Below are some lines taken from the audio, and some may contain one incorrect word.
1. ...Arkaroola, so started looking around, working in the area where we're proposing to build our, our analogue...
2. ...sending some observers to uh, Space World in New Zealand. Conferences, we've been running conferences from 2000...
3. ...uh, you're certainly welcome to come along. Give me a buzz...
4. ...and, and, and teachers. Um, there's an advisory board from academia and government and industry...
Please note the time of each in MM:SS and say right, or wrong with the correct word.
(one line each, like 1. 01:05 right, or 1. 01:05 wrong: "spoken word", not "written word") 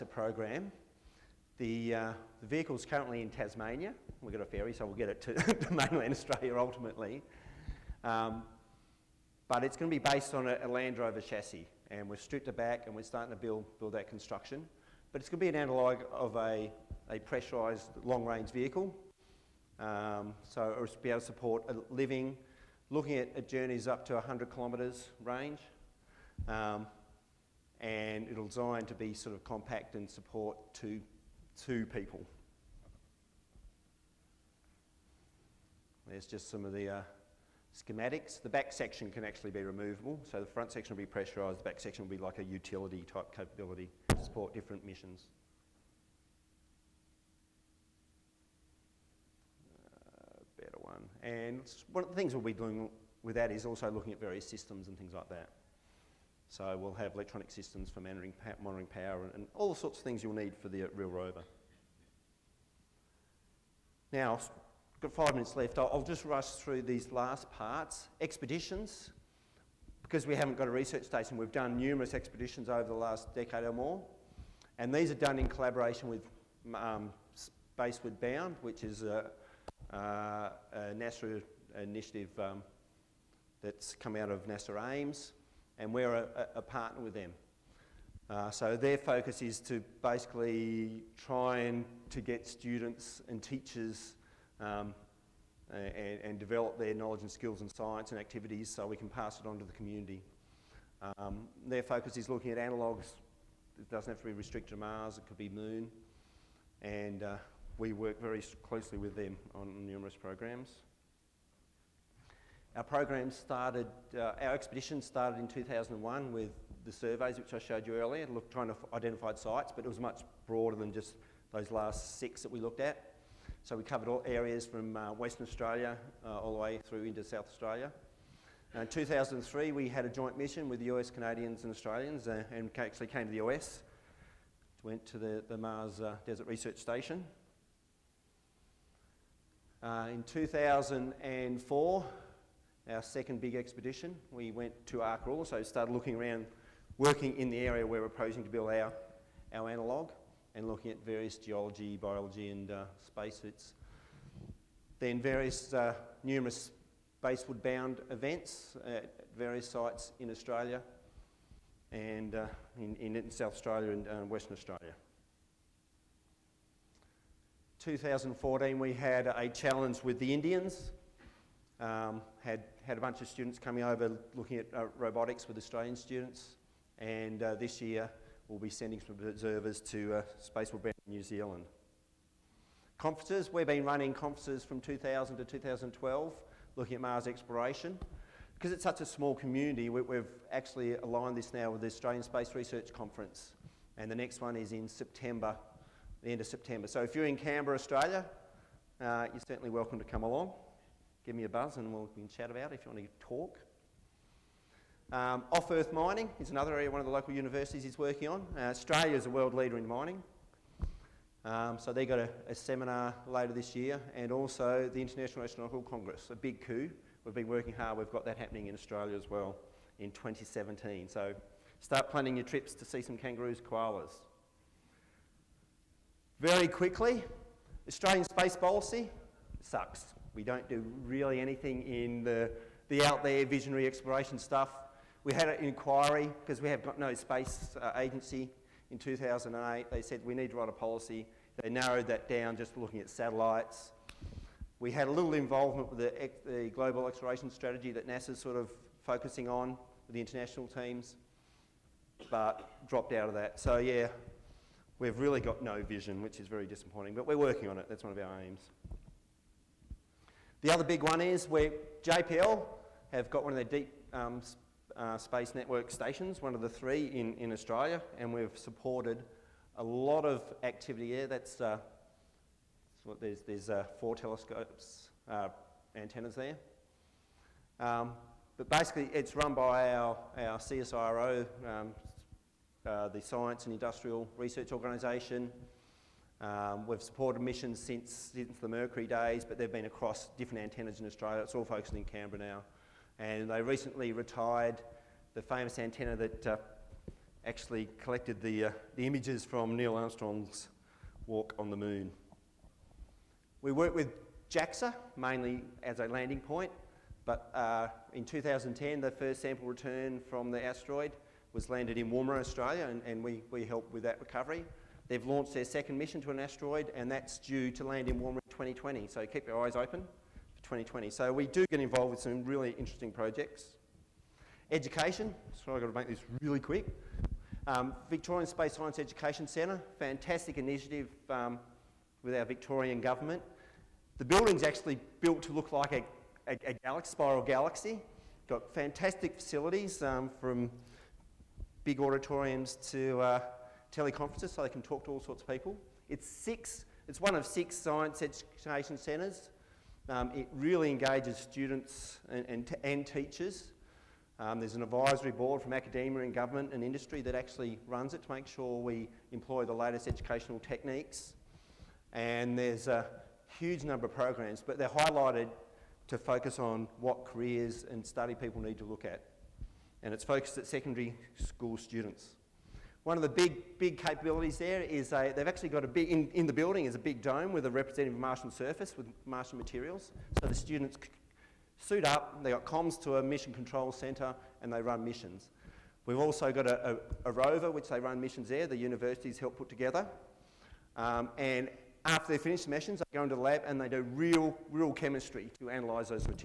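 1. 02:24 right
2. 02:58 right
3. 03:18 right
4. 05:52 right.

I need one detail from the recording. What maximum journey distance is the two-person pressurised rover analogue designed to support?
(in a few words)
100 kilometres.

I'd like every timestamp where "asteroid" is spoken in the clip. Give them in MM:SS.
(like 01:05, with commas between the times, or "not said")
05:10, 05:16.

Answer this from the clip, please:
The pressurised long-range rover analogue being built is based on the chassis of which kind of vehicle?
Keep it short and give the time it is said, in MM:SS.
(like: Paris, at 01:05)
Land Rover, at 00:10.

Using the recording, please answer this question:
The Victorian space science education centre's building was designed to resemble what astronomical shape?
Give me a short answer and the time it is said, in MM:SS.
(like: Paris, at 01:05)
spiral galaxy, at 05:37.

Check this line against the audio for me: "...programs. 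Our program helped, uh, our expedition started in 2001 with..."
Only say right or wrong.
wrong.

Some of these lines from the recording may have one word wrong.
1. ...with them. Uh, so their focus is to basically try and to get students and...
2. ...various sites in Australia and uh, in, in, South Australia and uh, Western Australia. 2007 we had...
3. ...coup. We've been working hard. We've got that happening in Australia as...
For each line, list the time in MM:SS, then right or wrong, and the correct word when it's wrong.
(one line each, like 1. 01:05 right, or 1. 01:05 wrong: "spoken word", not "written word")
1. 01:27 right
2. 02:39 wrong: "2014", not "2007"
3. 03:36 right.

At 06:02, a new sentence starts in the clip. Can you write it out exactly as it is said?
And there's a huge number of programs, but they're highlighted to focus on what careers and study people need to look at.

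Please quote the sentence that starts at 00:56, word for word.
So we'll have electronic systems for monitoring, monitoring power and, and all the sorts of things you'll need for the real rover.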